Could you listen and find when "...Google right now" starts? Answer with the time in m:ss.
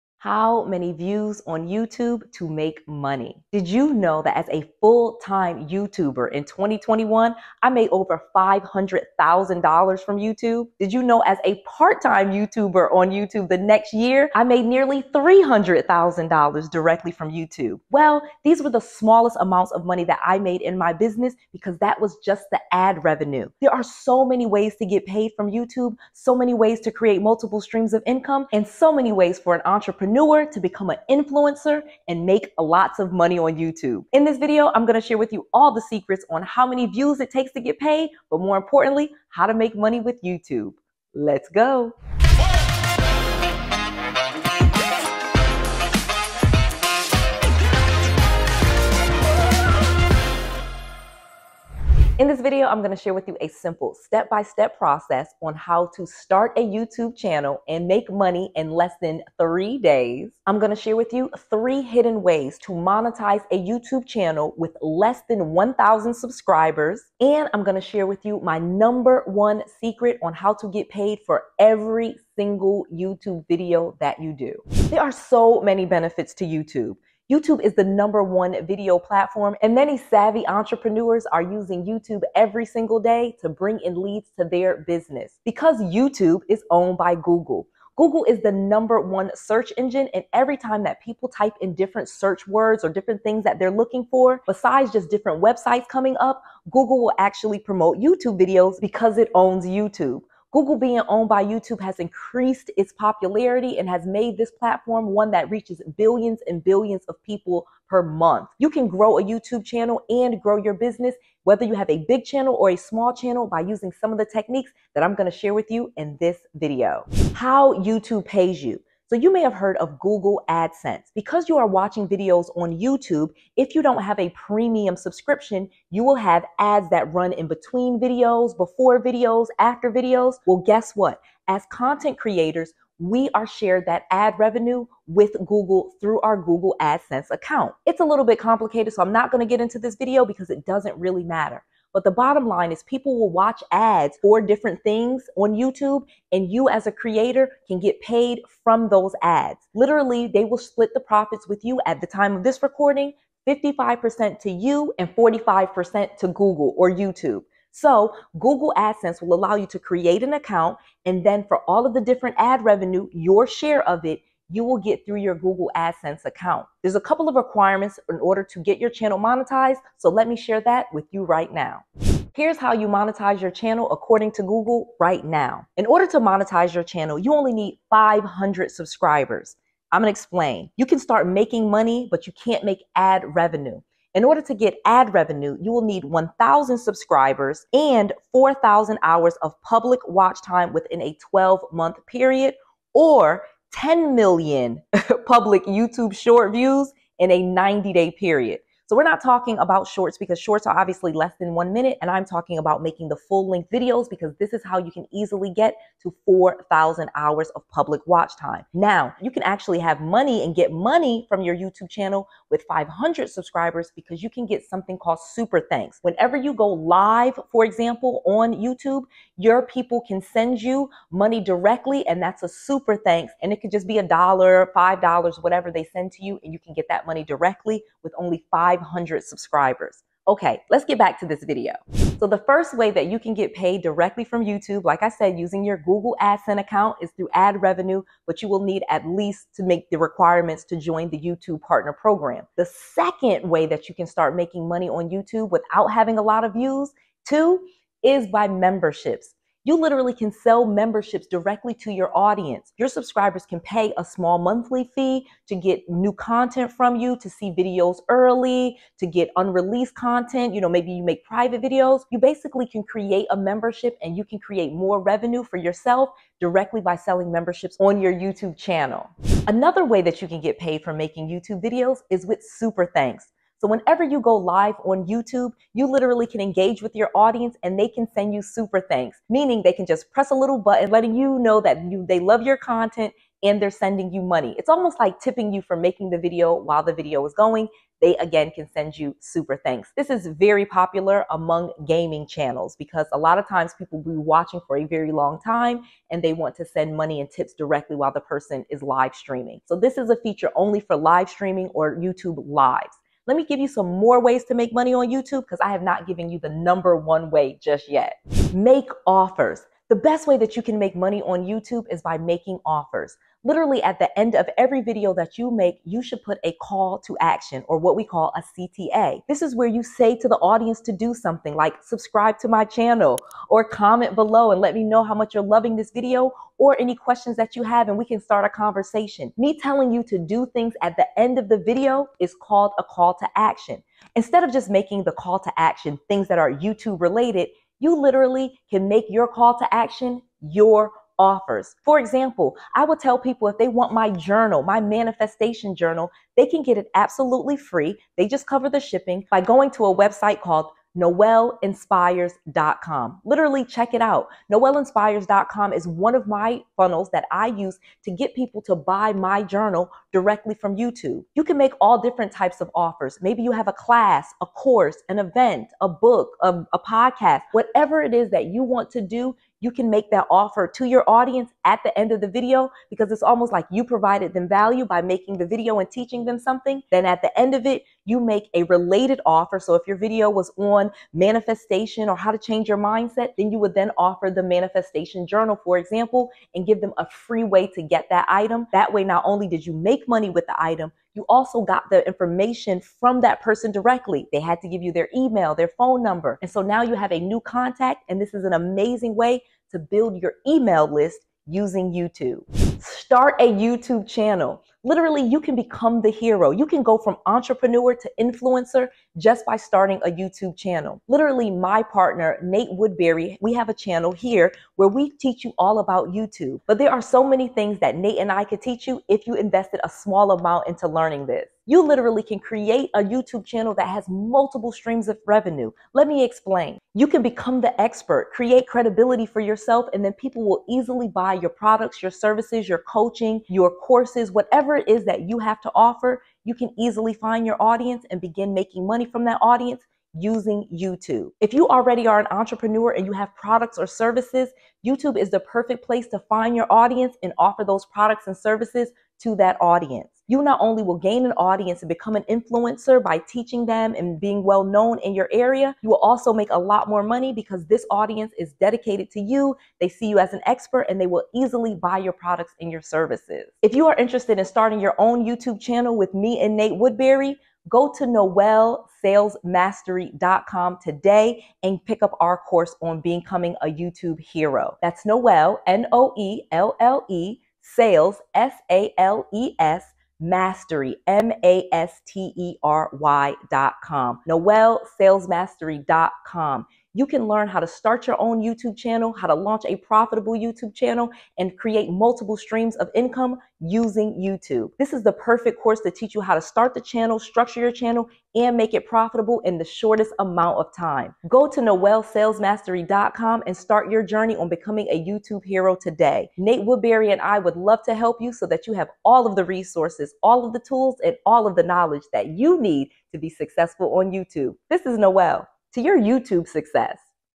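2:54.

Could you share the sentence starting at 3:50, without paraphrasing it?
Okay, let's get back to this video.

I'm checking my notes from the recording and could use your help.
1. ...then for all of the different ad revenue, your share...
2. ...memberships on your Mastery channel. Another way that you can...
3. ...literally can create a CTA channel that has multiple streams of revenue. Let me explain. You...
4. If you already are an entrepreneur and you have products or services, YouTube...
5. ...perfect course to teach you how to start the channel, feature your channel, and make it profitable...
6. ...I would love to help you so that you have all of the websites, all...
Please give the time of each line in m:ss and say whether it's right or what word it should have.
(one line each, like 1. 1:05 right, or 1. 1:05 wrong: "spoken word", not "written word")
1. 2:41 right
2. 4:27 wrong: "YouTube", not "Mastery"
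3. 7:01 wrong: "YouTube", not "CTA"
4. 7:21 right
5. 8:15 wrong: "structure", not "feature"
6. 8:27 wrong: "resources", not "websites".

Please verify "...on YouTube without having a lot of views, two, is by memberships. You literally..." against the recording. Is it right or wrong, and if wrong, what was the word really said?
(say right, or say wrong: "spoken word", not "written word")
right.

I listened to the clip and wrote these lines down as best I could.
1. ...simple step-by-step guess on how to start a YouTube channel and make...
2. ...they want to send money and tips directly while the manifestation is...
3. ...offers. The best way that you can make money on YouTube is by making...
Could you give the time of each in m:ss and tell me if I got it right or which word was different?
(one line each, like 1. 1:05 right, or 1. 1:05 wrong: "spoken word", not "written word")
1. 0:53 wrong: "process", not "guess"
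2. 4:56 wrong: "person", not "manifestation"
3. 5:09 right.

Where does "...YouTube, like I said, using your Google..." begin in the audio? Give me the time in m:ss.
3:54.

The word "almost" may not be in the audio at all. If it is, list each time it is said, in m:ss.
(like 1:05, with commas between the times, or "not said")
4:44, 6:13.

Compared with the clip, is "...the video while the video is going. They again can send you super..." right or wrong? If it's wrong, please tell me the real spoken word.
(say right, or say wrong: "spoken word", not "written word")
right.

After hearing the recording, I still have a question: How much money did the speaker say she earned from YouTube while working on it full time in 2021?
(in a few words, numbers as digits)
over $500,000.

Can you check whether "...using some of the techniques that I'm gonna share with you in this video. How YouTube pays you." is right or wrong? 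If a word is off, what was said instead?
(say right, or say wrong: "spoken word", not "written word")
right.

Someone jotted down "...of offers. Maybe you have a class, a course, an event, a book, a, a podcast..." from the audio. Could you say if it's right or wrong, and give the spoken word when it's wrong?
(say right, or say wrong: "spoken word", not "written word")
right.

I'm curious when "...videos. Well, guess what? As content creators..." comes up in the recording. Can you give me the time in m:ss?
2:09.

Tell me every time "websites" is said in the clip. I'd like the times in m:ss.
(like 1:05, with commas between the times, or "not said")
1:35, 5:49.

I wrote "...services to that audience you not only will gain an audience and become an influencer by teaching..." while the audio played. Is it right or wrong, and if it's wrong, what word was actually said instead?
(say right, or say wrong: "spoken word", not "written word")
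right.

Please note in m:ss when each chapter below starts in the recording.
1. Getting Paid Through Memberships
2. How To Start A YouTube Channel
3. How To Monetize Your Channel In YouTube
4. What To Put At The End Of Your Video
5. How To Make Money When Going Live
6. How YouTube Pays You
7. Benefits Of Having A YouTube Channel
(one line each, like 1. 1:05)
1. 3:52
2. 6:42
3. 2:52
4. 5:08
5. 4:29
6. 1:57
7. 1:14.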